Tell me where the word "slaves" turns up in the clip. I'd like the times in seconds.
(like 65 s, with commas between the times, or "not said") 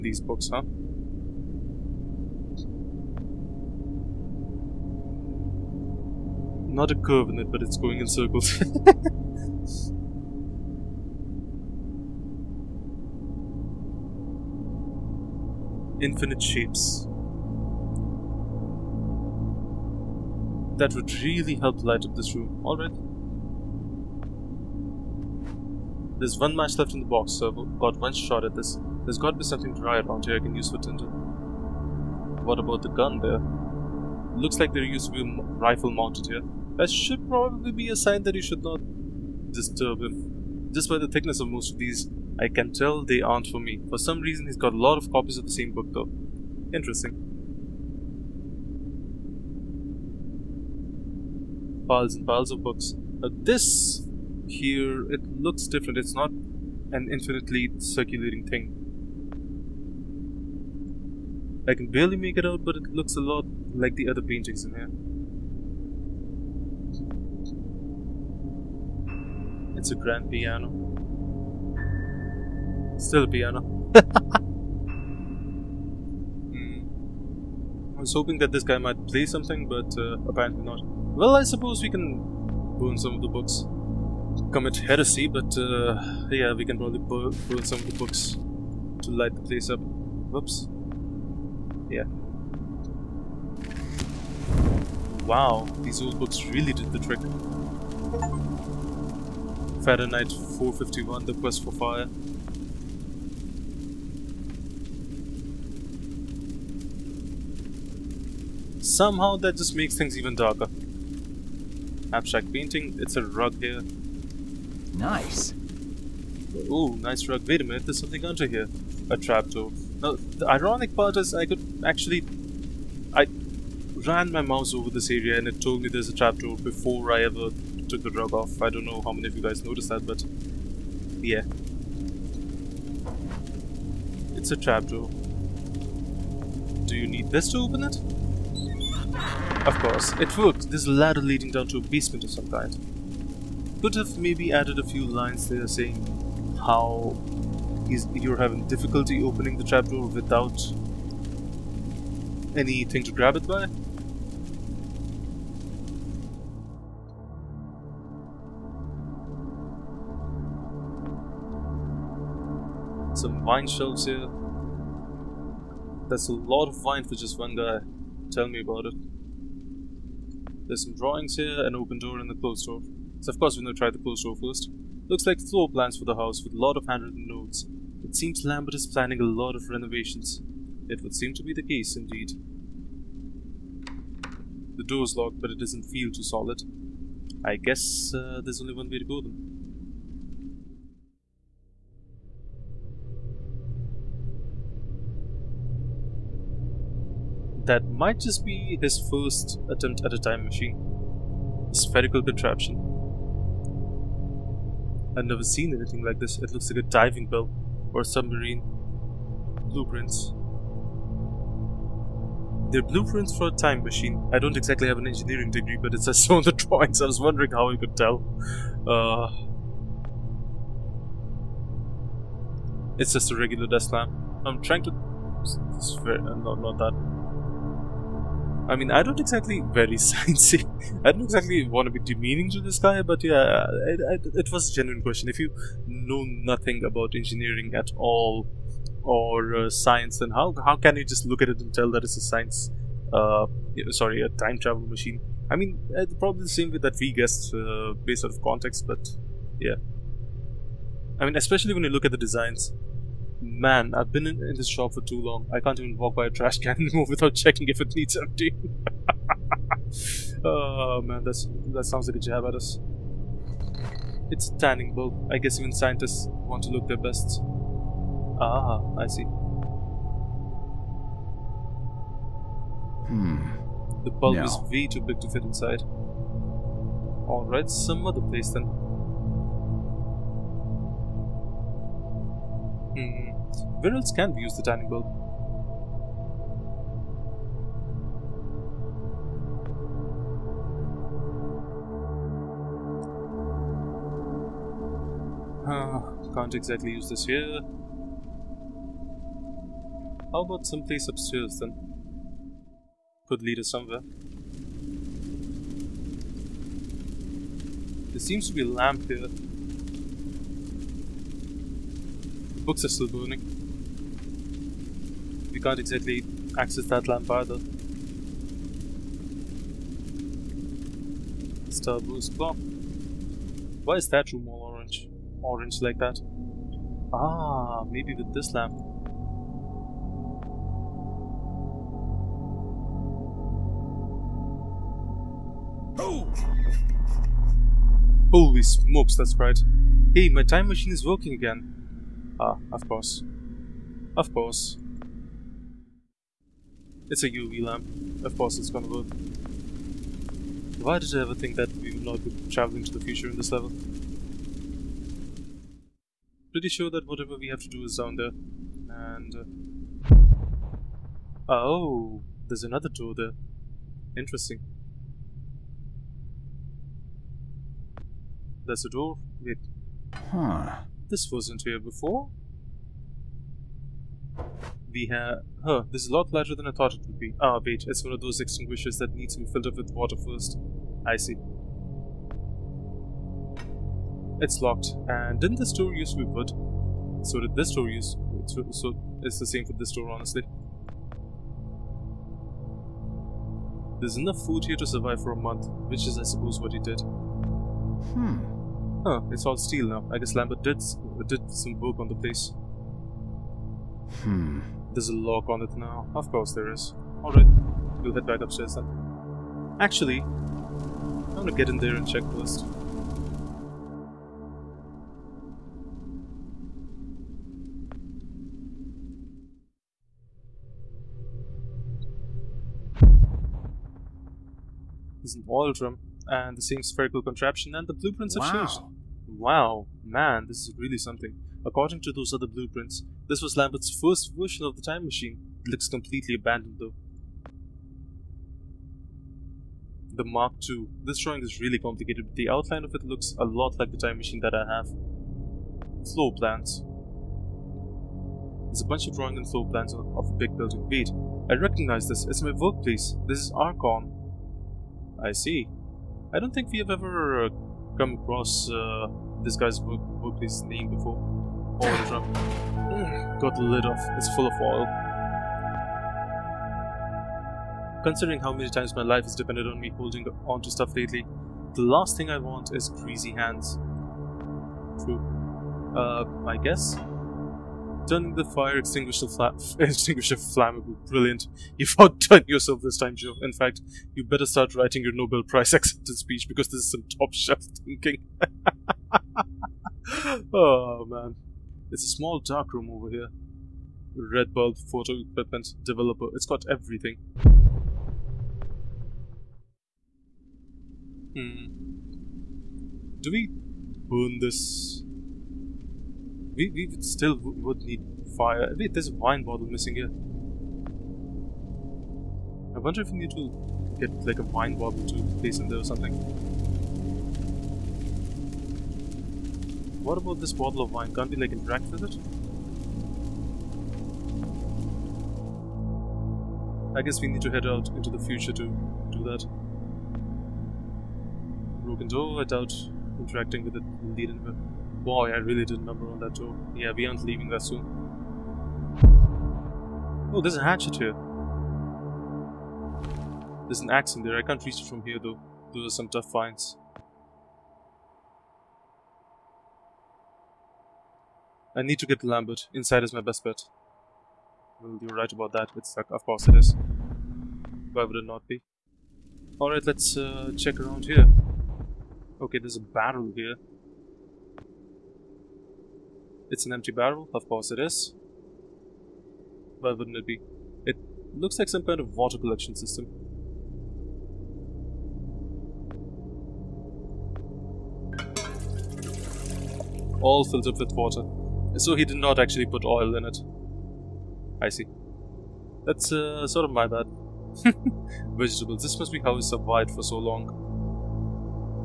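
not said.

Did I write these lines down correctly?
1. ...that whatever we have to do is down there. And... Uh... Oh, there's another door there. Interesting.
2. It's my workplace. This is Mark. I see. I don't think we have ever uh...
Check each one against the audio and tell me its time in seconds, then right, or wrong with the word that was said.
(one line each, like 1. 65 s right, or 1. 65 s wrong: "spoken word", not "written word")
1. 356 s right
2. 452 s wrong: "Archon", not "Mark".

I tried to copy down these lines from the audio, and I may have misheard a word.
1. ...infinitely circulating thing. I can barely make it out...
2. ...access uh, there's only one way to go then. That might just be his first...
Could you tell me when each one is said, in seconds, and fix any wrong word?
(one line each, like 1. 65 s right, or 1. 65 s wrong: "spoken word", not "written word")
1. 57 s right
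2. 187 s wrong: "guess", not "access".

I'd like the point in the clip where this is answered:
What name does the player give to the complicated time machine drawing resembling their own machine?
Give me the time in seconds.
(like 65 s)
440 s.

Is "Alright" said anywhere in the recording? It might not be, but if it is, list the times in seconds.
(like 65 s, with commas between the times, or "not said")
22 s, 275 s, 407 s, 559 s.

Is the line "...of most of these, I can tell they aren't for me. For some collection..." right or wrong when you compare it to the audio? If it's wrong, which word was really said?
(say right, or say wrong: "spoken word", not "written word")
wrong: "reason", not "collection".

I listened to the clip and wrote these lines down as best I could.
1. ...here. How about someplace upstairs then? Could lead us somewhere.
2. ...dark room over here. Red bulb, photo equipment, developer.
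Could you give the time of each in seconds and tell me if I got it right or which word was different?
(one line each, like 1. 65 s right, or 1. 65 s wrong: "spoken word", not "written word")
1. 297 s right
2. 492 s right.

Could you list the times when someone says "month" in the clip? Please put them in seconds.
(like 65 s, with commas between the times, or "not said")
395 s.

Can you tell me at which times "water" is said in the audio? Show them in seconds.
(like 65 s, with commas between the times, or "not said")
379 s, 572 s, 580 s.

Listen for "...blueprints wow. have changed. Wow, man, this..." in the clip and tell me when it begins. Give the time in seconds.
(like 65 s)
427 s.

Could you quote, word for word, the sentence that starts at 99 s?
Fahrenheit 451, The Quest for Fire.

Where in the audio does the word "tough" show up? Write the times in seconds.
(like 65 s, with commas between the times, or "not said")
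546 s.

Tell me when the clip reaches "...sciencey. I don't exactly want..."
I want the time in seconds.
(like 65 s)
230 s.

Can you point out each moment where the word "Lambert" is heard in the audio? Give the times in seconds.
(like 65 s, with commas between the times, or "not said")
178 s, 400 s, 433 s, 552 s.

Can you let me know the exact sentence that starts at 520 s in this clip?
What about this bottle of wine?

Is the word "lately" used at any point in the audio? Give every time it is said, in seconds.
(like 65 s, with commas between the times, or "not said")
470 s.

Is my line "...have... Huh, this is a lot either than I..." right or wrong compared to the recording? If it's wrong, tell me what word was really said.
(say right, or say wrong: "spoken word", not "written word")
wrong: "larger", not "either".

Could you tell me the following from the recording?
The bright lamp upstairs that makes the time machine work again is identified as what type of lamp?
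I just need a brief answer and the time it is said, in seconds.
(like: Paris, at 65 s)
UV lamp, at 347 s.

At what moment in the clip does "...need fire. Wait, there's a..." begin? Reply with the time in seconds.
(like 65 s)
507 s.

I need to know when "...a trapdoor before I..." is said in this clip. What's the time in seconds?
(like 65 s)
126 s.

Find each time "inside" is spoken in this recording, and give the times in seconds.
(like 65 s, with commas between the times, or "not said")
275 s, 552 s.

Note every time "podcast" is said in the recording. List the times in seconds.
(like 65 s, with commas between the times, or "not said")
not said.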